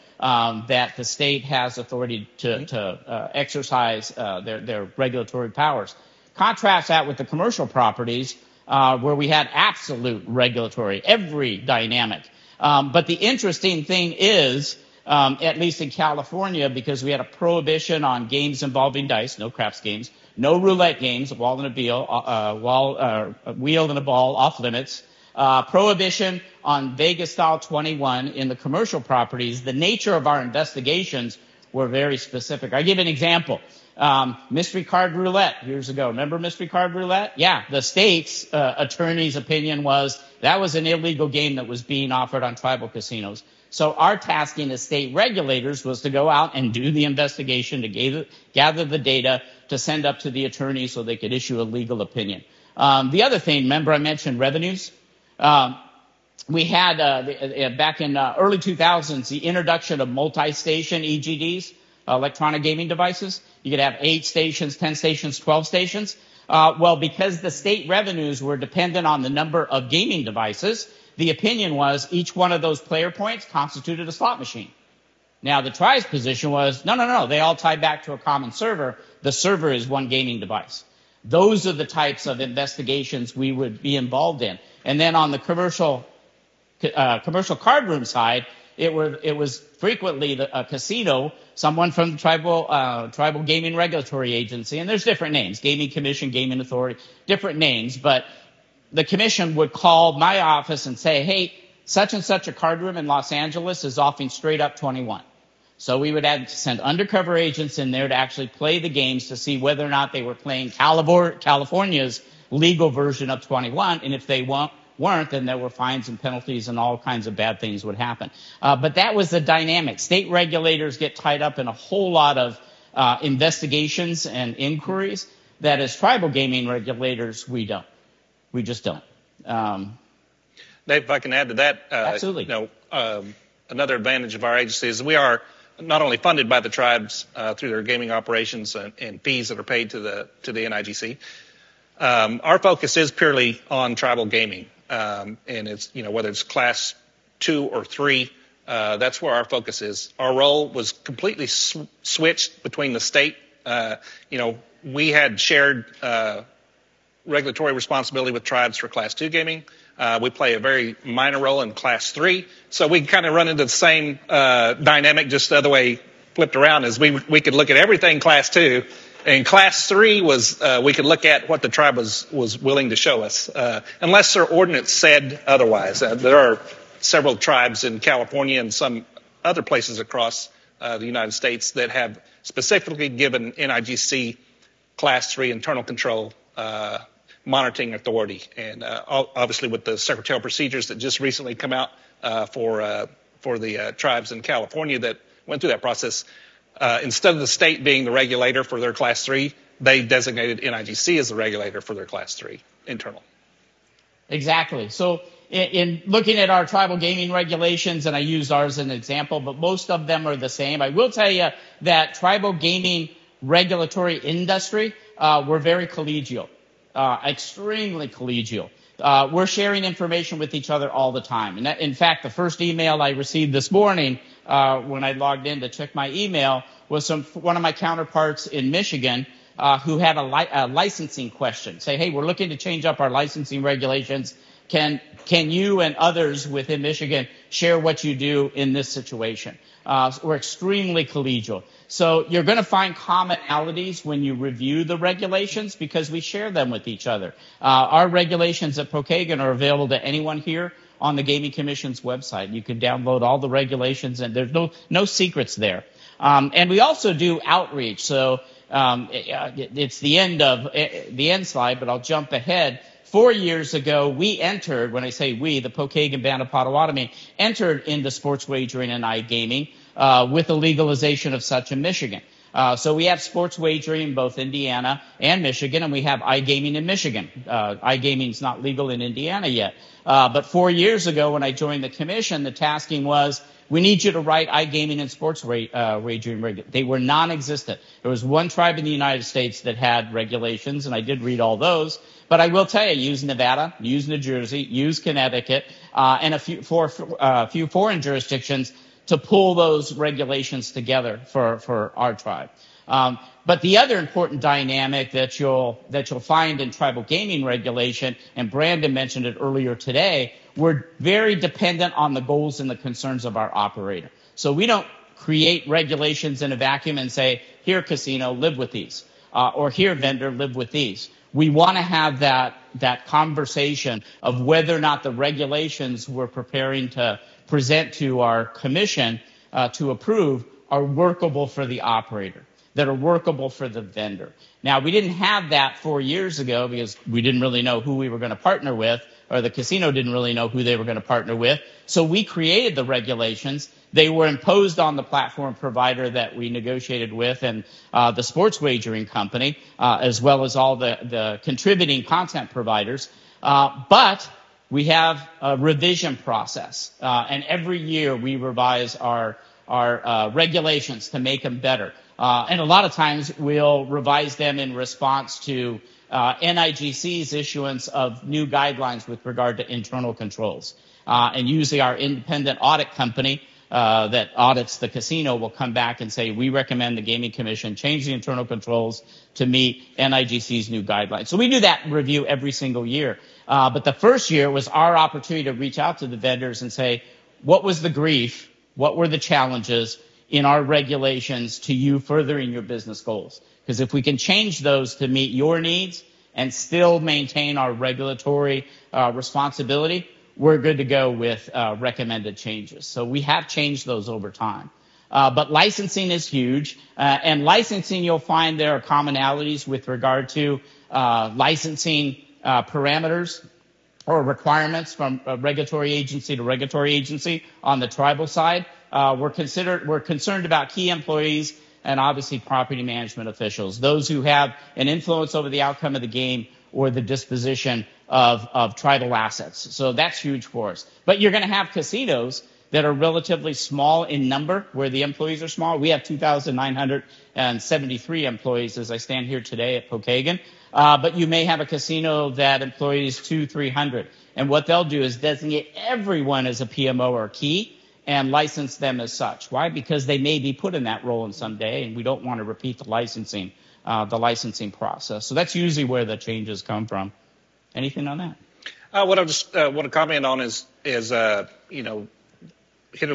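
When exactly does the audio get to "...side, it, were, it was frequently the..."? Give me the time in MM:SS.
01:28.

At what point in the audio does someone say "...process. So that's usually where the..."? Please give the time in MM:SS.
07:34.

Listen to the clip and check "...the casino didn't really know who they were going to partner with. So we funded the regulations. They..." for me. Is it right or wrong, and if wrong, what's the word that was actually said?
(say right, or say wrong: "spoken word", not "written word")
wrong: "created", not "funded".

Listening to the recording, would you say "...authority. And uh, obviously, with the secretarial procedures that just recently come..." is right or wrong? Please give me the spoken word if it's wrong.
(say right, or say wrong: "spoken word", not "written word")
right.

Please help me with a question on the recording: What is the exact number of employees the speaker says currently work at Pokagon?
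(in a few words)
2,973.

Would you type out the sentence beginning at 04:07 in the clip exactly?
Uh, our regulations at Pokagon are available to anyone here on the Gaming Commission's website.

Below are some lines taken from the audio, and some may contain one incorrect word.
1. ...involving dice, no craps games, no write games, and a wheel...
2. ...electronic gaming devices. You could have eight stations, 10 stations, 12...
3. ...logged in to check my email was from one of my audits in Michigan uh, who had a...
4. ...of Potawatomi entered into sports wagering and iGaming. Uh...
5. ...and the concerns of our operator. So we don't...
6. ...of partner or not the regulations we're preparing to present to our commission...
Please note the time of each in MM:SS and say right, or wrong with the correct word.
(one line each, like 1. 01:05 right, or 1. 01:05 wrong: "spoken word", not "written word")
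1. 00:18 wrong: "roulette", not "write"
2. 01:02 right
3. 03:45 wrong: "counterparts", not "audits"
4. 04:26 right
5. 05:12 right
6. 05:24 wrong: "whether", not "partner".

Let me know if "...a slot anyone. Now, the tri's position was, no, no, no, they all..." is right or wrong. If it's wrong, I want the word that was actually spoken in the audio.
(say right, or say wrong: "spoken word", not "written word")
wrong: "machine", not "anyone".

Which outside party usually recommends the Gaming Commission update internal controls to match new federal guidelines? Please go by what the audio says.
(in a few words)
Independent audit company.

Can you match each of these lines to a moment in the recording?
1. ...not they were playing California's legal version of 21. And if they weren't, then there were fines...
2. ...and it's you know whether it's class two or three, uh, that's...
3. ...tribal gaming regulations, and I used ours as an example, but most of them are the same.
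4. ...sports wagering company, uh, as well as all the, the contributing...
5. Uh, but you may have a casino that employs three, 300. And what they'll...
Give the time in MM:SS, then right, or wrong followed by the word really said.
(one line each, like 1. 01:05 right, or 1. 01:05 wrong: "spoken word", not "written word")
1. 01:49 right
2. 02:25 right
3. 03:26 right
4. 05:48 right
5. 07:20 wrong: "two", not "three".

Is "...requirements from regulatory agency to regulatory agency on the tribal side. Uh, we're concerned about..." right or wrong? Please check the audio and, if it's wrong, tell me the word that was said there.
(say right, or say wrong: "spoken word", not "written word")
right.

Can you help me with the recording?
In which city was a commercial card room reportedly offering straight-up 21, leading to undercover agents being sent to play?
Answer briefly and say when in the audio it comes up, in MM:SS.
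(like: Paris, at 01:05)
Los Angeles, at 01:43.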